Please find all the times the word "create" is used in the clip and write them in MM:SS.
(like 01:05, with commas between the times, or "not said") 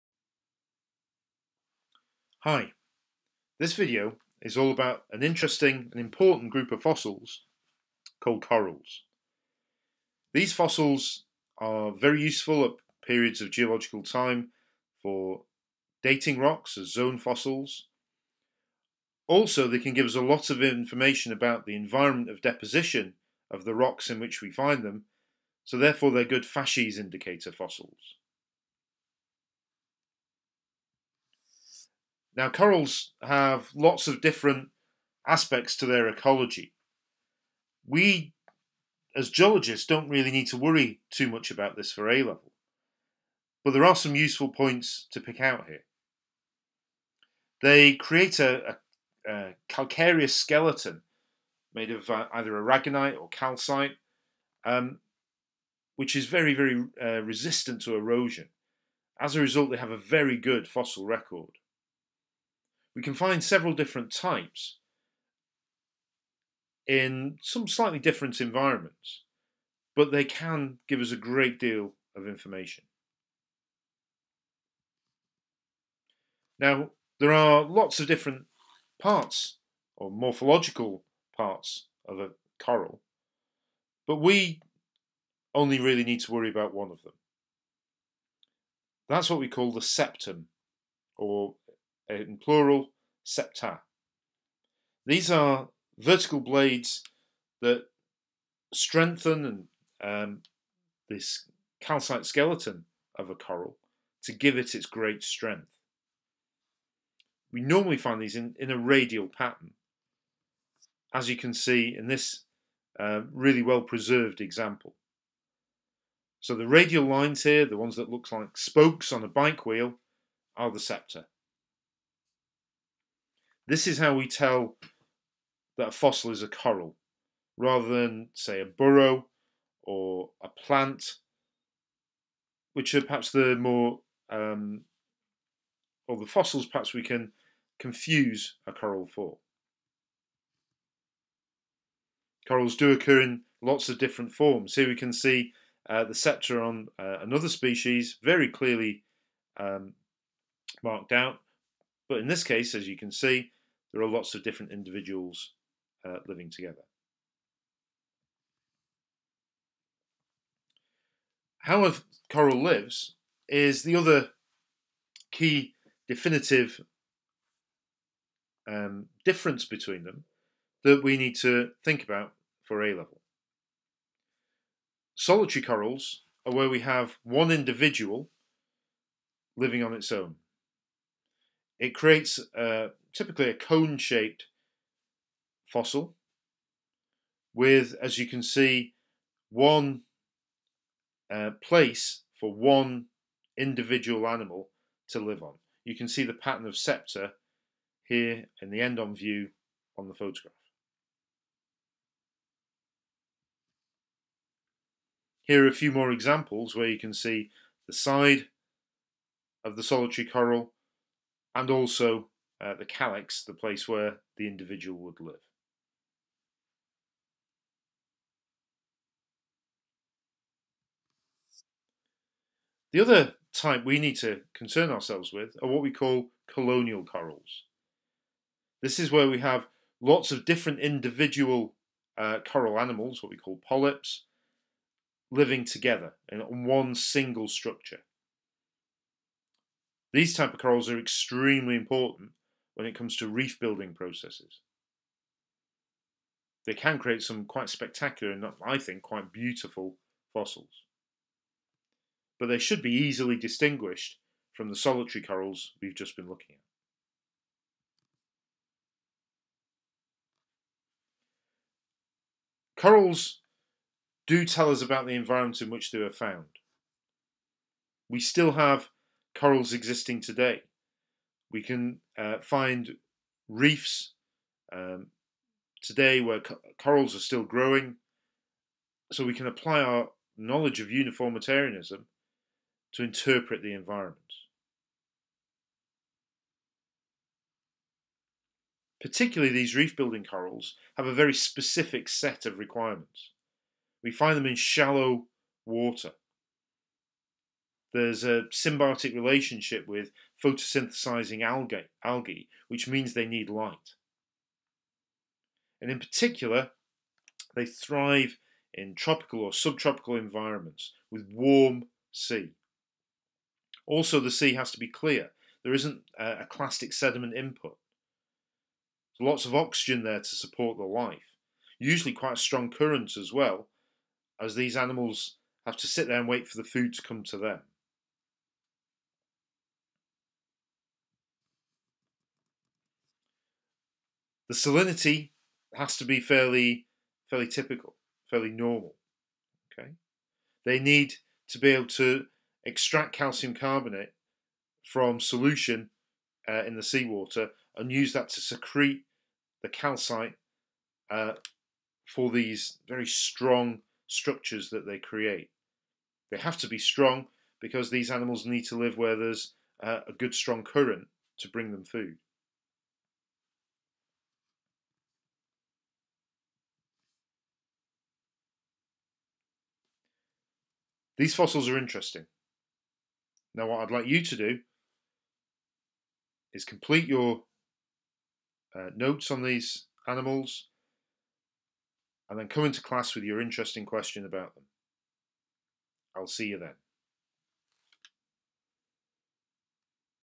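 00:47, 03:01, 04:06, 05:54.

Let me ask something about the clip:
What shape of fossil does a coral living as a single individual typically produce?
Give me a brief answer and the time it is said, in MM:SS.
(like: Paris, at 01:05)
cone-shaped, at 03:03.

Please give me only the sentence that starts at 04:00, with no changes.
These type of corals are extremely important when it comes to reef building processes.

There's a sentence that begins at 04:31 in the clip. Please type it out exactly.
We can uh, find reefs um, today where co corals are still growing.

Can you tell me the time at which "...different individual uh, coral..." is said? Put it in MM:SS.
03:50.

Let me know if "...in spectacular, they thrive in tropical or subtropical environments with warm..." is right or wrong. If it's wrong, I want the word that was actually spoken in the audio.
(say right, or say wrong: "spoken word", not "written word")
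wrong: "particular", not "spectacular".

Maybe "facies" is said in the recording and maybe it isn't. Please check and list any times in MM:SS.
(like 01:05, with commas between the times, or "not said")
00:26.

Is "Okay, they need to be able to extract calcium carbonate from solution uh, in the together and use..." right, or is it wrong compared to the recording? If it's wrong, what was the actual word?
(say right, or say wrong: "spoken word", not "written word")
wrong: "seawater", not "together".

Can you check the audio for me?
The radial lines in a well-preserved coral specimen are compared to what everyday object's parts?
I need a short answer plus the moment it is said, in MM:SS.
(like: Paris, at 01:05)
spokes on a bike wheel, at 01:58.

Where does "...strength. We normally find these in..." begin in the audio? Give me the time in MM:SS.
01:45.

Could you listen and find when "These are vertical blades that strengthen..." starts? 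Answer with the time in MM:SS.
01:35.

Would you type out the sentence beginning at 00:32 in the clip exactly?
Now, corals have lots of different aspects to their ecology.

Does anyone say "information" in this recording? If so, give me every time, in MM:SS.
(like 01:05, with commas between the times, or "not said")
00:20, 01:12.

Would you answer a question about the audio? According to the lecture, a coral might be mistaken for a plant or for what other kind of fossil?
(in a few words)
a burrow.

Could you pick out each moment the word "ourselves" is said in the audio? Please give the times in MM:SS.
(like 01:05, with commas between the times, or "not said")
03:44.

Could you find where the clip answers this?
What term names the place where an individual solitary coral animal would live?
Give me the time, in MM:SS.
03:32.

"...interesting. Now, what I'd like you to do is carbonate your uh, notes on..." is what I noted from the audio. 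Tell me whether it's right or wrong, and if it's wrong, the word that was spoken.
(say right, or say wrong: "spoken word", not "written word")
wrong: "complete", not "carbonate".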